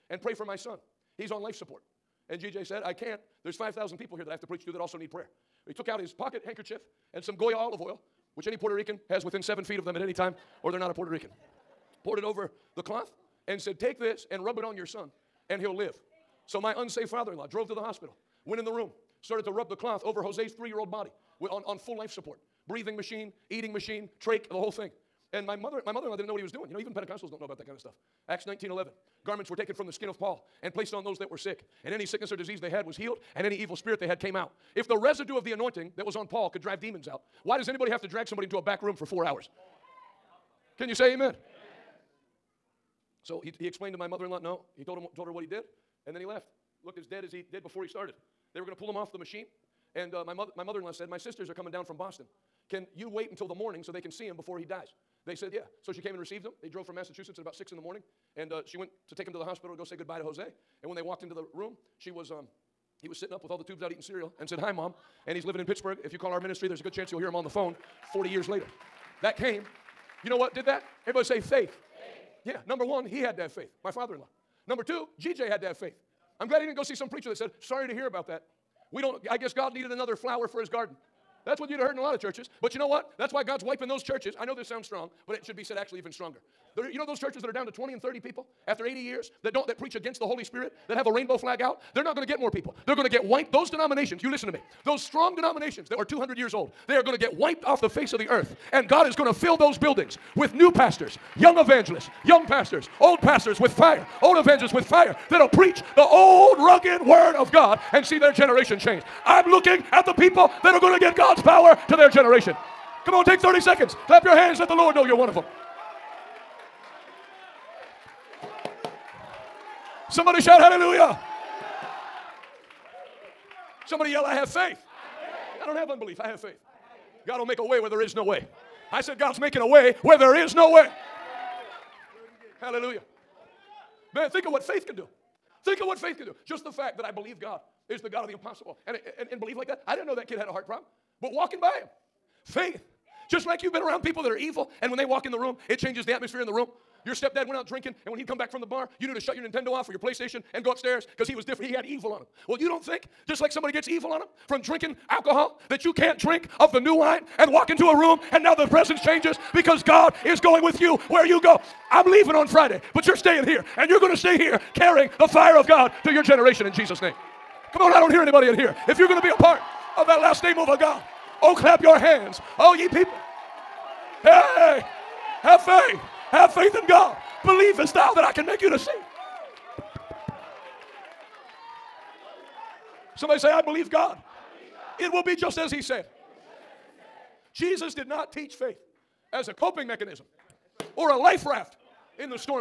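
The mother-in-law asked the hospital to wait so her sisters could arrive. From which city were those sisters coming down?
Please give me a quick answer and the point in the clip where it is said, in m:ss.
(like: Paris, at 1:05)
Boston, at 0:51.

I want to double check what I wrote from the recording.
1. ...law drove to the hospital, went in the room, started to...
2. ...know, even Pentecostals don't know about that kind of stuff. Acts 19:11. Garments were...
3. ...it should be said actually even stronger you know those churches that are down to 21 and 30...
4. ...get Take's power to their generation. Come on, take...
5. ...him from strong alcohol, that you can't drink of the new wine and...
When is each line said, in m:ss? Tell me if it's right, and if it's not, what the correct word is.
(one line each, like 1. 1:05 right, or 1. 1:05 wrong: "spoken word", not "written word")
1. 0:17 right
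2. 0:26 right
3. 1:25 wrong: "20", not "21"
4. 1:51 wrong: "God", not "Take"
5. 2:34 wrong: "drinking", not "strong".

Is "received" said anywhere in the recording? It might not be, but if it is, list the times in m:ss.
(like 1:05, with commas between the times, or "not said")
0:56.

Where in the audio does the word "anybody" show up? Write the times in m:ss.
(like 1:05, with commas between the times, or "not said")
0:37, 2:48.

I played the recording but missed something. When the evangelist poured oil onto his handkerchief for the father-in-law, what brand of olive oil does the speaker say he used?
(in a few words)
Goya.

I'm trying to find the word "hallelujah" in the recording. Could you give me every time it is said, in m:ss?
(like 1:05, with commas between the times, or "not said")
2:00, 2:12.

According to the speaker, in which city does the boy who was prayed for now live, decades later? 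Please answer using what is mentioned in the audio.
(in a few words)
Pittsburgh.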